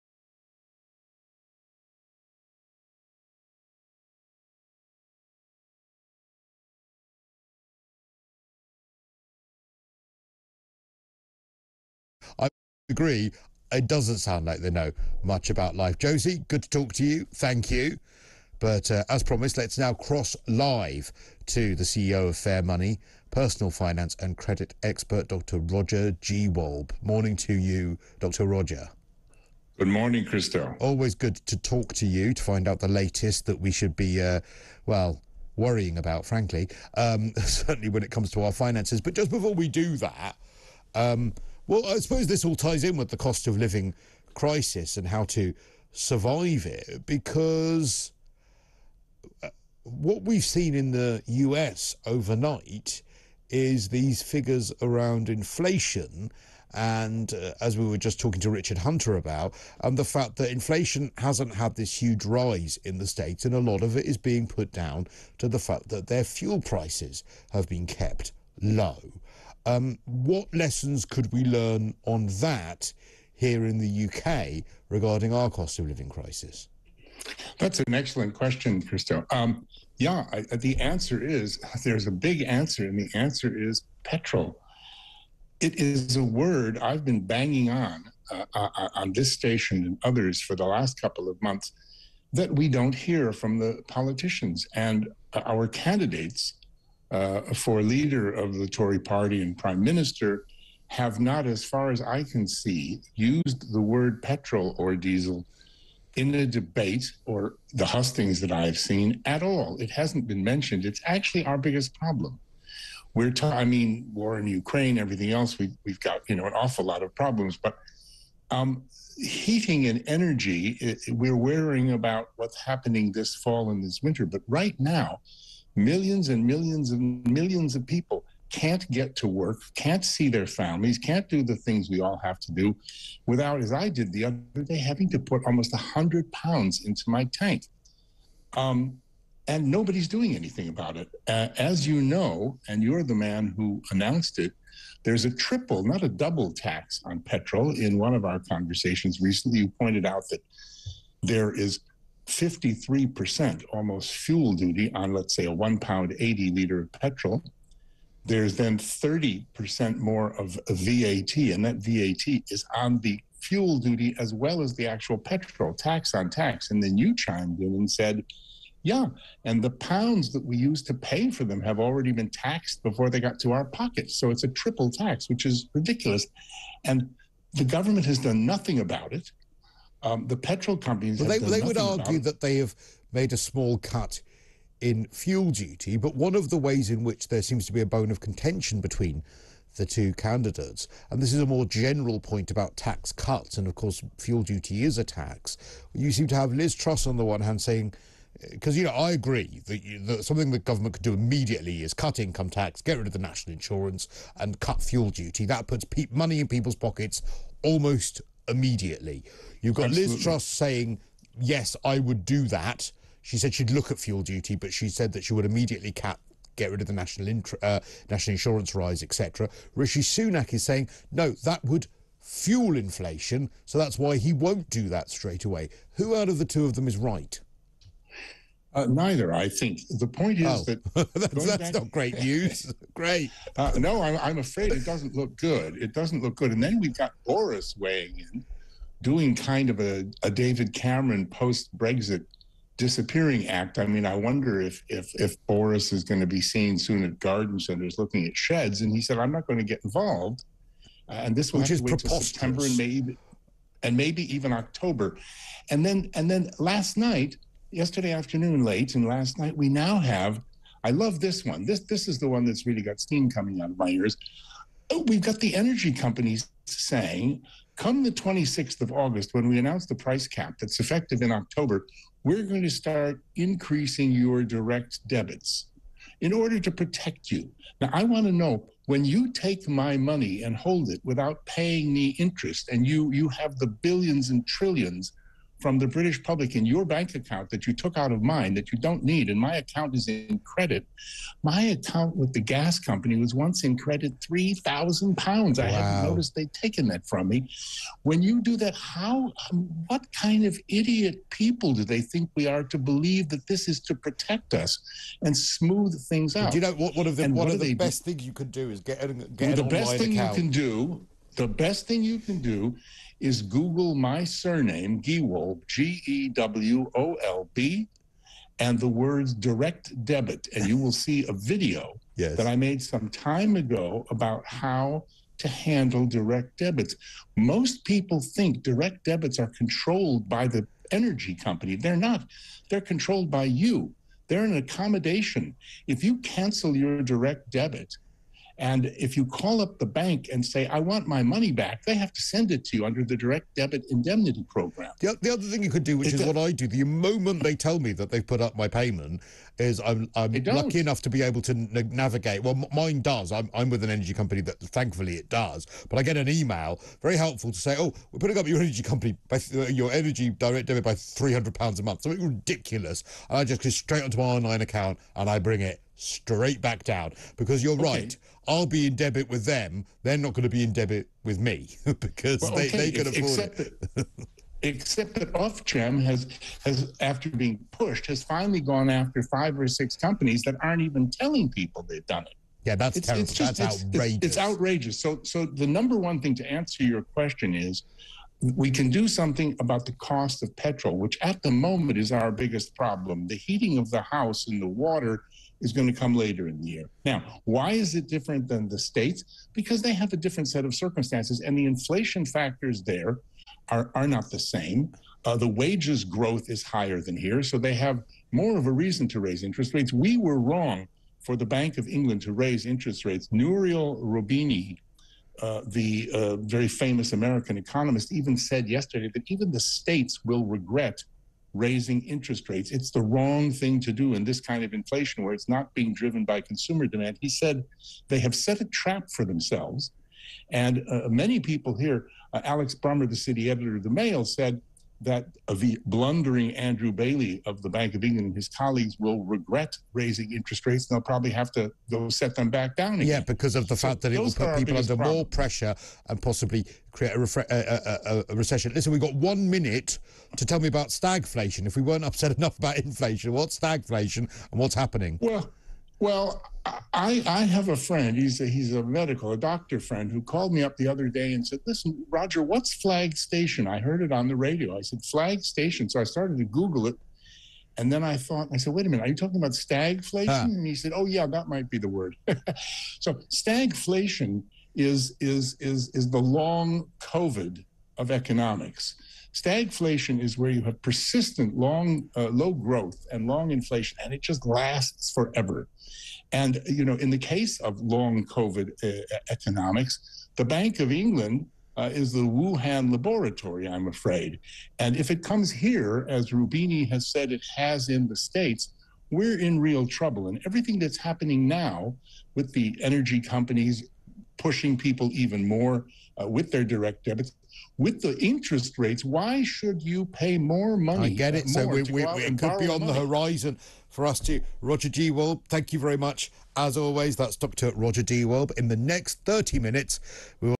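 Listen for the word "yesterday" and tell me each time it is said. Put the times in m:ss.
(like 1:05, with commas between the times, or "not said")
4:17, 6:58.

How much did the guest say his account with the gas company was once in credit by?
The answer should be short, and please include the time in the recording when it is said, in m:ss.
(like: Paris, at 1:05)
£3,000, at 4:54.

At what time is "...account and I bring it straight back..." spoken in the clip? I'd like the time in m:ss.
6:04.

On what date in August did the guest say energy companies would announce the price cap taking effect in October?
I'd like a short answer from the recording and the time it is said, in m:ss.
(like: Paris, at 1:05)
26th of August, at 4:28.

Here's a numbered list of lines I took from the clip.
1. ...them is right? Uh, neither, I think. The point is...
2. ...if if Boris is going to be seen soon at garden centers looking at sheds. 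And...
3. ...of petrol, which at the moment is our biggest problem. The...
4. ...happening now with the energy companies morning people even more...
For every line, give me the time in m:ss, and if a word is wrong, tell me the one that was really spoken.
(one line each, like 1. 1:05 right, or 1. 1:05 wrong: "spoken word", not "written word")
1. 3:46 right
2. 4:04 right
3. 6:30 right
4. 8:20 wrong: "pushing", not "morning".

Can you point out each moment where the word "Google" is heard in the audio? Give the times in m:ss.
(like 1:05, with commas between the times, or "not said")
5:13, 7:46.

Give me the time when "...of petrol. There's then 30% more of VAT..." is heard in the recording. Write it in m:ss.
2:36.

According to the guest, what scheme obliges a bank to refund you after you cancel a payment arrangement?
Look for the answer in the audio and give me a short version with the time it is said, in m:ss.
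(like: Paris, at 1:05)
direct debit indemnity program, at 5:43.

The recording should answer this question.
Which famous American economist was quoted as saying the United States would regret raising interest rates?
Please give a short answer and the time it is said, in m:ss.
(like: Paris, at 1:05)
Nouriel Roubini, at 6:53.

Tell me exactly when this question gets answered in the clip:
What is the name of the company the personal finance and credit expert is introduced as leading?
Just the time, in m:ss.
0:22.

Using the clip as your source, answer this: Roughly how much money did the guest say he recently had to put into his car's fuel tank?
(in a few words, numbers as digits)
almost £100.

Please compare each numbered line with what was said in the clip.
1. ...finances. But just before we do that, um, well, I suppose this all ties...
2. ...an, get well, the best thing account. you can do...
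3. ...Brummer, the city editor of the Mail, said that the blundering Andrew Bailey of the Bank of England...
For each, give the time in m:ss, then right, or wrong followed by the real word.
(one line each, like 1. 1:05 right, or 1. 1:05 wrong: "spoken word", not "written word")
1. 0:38 right
2. 5:09 right
3. 7:12 right.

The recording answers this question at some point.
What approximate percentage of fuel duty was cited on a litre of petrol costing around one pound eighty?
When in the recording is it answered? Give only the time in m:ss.
2:32.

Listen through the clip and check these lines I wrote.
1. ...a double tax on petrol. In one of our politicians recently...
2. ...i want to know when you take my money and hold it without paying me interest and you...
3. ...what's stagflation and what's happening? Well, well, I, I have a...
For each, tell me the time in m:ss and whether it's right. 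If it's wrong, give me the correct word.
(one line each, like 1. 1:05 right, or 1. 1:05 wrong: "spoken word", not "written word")
1. 2:26 wrong: "conversations", not "politicians"
2. 4:37 right
3. 7:33 right.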